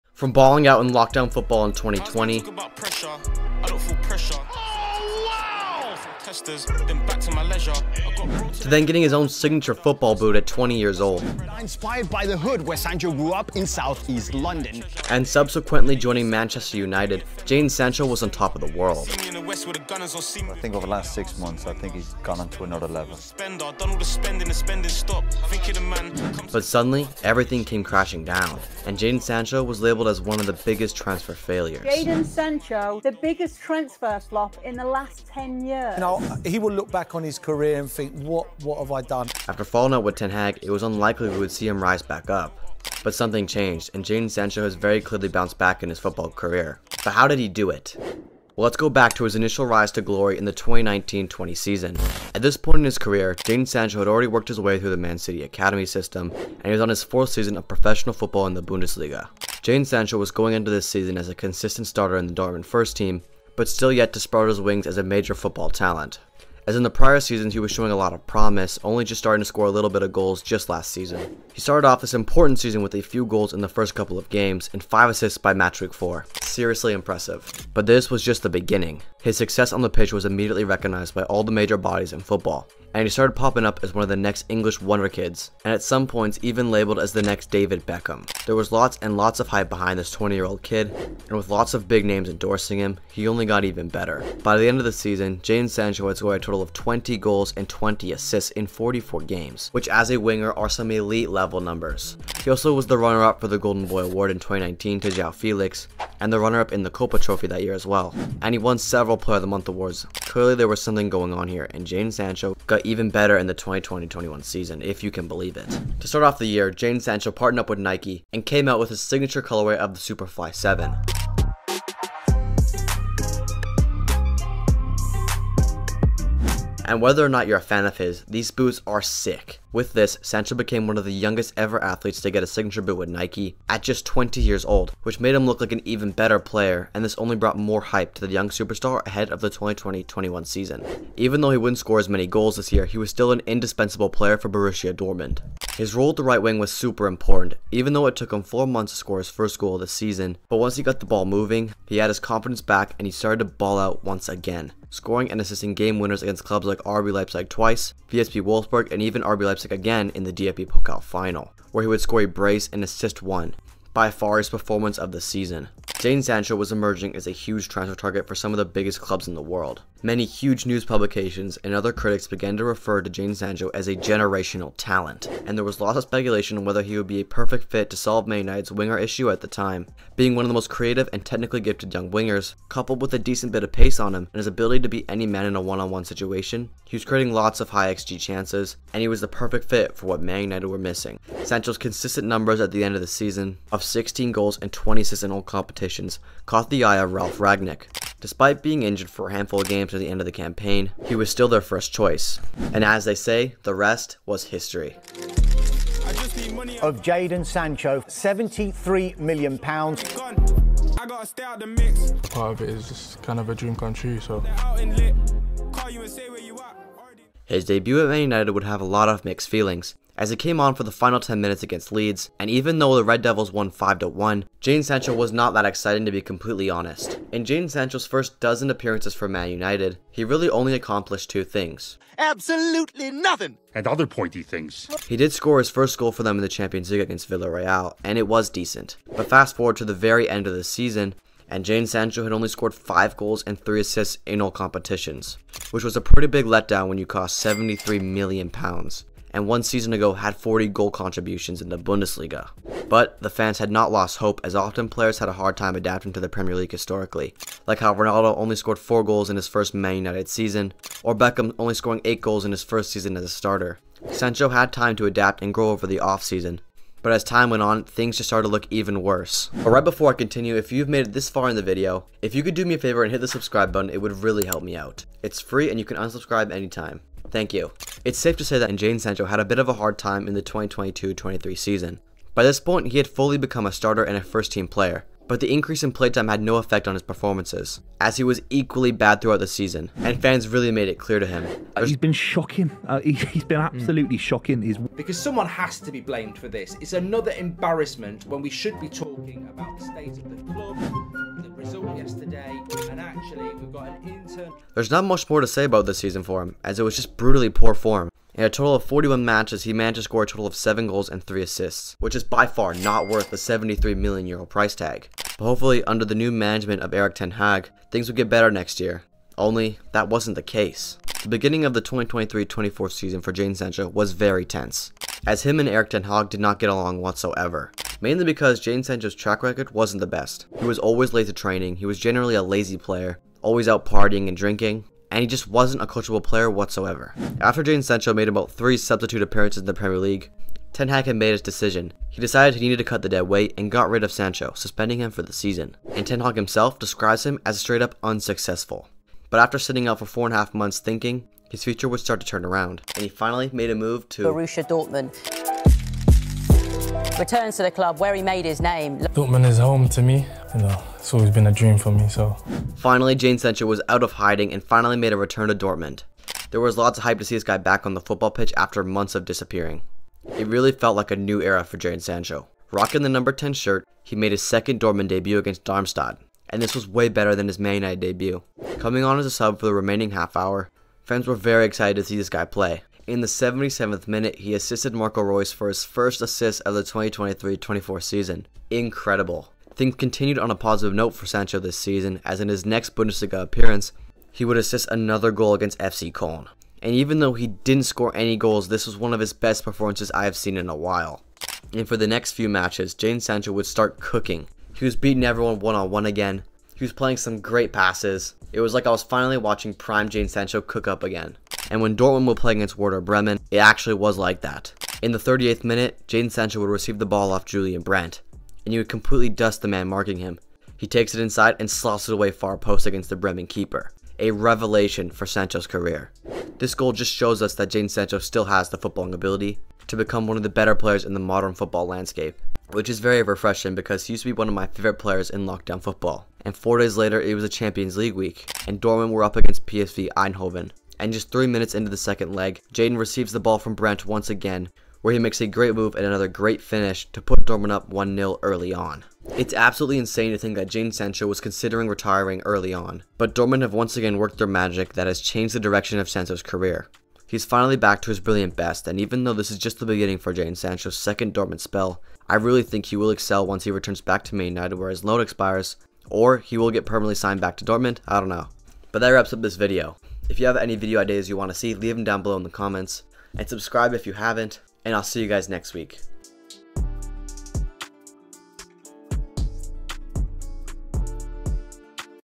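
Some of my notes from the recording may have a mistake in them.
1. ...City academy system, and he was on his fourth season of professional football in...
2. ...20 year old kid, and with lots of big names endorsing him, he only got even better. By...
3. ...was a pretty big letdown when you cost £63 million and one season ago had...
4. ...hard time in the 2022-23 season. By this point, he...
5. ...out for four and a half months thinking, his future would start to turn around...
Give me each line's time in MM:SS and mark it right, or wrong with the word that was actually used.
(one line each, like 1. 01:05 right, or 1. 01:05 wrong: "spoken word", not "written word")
1. 00:55 right
2. 01:30 right
3. 04:05 wrong: "73", not "63"
4. 04:39 right
5. 05:49 right.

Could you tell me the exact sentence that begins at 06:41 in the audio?
And for the next few matches, Jadon Sancho would start cooking.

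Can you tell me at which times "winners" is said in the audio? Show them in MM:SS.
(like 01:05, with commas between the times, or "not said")
02:35.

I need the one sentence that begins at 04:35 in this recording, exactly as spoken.
It's free and you can unsubscribe anytime.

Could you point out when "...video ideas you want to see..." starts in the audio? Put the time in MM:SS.
07:50.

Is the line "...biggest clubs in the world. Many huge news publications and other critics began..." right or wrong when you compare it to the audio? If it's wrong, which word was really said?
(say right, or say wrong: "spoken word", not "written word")
right.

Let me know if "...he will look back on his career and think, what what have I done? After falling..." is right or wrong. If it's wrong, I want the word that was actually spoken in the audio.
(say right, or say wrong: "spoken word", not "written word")
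right.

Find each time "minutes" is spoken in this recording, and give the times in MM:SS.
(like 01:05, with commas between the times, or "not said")
03:41, 06:24, 06:55, 07:21.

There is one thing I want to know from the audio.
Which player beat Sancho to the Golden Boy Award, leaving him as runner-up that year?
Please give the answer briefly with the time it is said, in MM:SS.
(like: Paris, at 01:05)
João Felix, at 01:45.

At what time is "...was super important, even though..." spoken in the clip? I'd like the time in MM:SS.
02:26.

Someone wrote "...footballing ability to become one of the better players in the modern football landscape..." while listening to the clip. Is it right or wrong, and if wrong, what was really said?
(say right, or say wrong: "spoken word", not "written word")
right.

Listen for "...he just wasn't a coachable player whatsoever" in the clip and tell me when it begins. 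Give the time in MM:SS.
05:35.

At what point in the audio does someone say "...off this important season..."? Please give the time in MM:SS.
01:11.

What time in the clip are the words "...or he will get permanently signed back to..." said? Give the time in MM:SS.
07:46.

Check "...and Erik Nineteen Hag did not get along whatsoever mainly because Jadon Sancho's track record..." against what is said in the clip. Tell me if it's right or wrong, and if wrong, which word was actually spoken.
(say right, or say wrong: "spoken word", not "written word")
wrong: "Ten", not "Nineteen".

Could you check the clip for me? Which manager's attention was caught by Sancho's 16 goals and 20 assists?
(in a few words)
Ralf Rangnick.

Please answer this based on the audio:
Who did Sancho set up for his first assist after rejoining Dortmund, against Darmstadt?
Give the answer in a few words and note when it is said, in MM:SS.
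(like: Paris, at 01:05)
Marco Reus, at 06:24.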